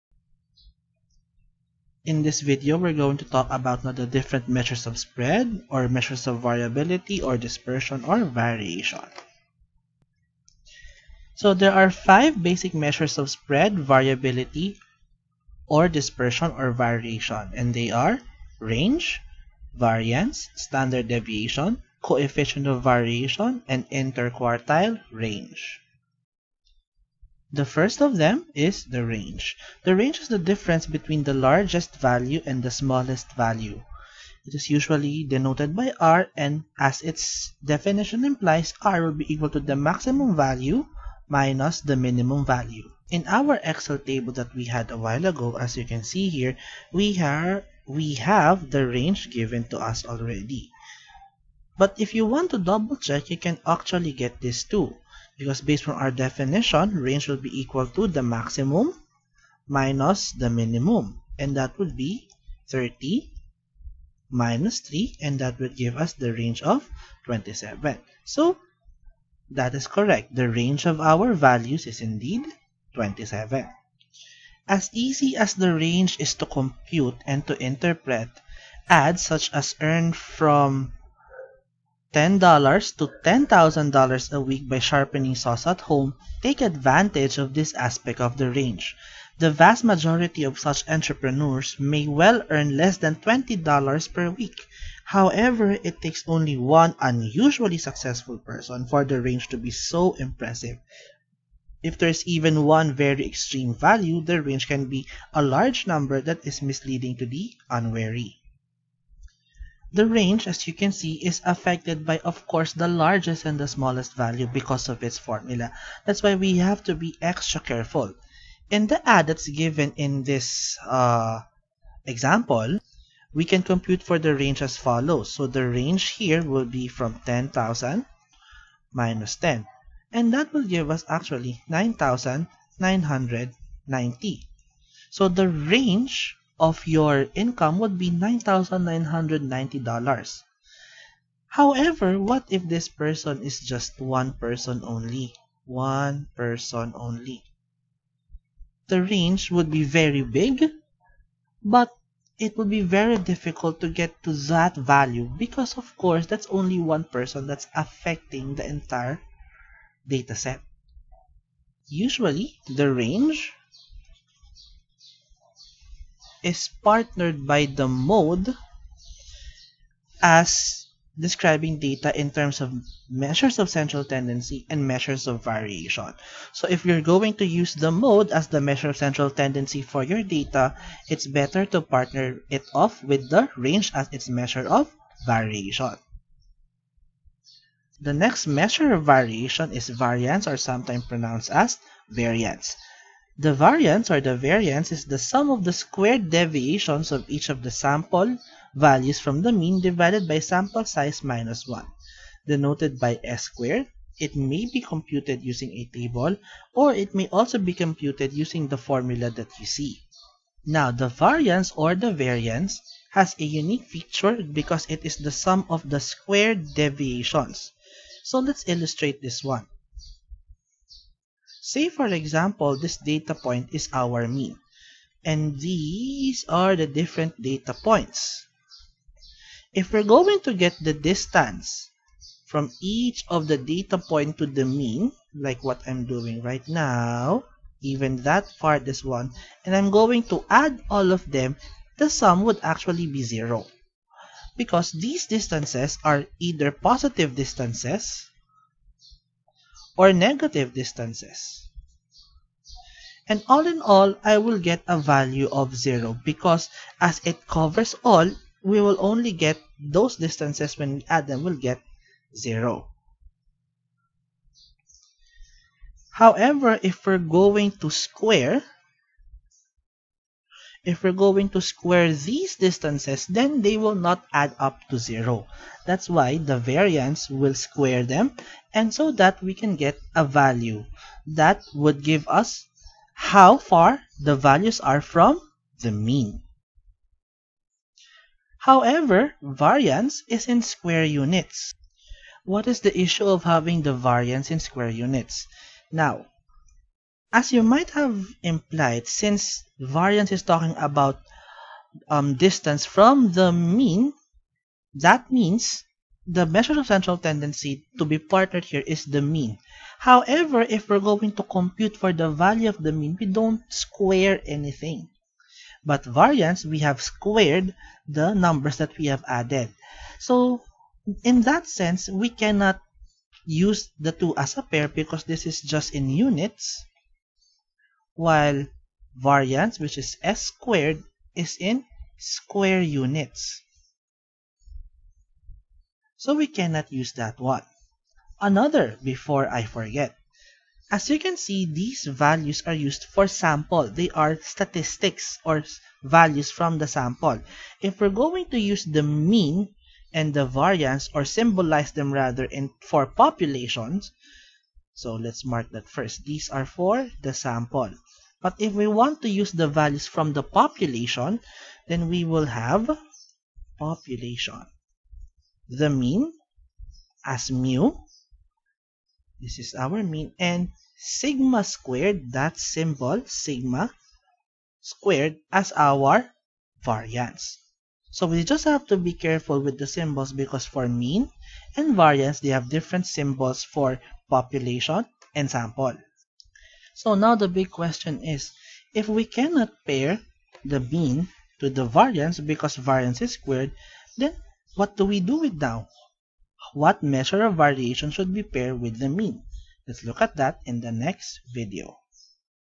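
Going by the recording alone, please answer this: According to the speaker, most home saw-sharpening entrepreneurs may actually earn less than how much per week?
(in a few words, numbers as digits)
$20.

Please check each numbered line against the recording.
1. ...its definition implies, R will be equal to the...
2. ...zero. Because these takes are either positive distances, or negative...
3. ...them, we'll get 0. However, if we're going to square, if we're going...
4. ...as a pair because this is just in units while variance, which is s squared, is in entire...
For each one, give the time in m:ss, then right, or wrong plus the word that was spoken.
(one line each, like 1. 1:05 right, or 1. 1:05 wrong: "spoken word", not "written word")
1. 0:37 right
2. 4:03 wrong: "distances", not "takes"
3. 4:21 right
4. 5:24 wrong: "square", not "entire".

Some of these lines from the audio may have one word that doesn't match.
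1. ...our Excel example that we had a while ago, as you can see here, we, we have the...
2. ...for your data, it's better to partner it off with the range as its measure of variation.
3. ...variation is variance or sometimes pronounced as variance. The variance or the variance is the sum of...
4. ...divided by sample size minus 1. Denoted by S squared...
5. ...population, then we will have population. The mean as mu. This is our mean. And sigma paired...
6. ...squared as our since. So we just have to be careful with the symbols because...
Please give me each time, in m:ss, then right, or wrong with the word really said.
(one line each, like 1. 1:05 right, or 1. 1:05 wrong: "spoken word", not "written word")
1. 0:43 wrong: "table", not "example"
2. 2:59 right
3. 3:09 right
4. 3:19 right
5. 6:00 wrong: "squared", not "paired"
6. 6:14 wrong: "variance", not "since".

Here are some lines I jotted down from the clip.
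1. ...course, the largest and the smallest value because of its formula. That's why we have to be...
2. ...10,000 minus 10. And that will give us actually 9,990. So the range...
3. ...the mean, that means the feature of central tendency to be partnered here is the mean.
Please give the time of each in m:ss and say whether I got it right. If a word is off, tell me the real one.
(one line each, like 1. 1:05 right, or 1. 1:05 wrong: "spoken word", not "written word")
1. 1:52 right
2. 2:07 right
3. 5:03 wrong: "measure", not "feature".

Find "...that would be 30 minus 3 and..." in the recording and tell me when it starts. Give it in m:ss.
1:01.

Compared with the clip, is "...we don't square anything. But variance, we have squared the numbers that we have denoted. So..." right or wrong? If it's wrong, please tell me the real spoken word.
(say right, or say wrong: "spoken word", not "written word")
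wrong: "added", not "denoted".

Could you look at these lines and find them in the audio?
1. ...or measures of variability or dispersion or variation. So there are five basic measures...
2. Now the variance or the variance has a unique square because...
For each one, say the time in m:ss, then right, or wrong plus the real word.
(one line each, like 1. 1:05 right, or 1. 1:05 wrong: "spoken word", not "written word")
1. 0:05 right
2. 3:30 wrong: "feature", not "square".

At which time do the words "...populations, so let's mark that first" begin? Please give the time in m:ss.
5:53.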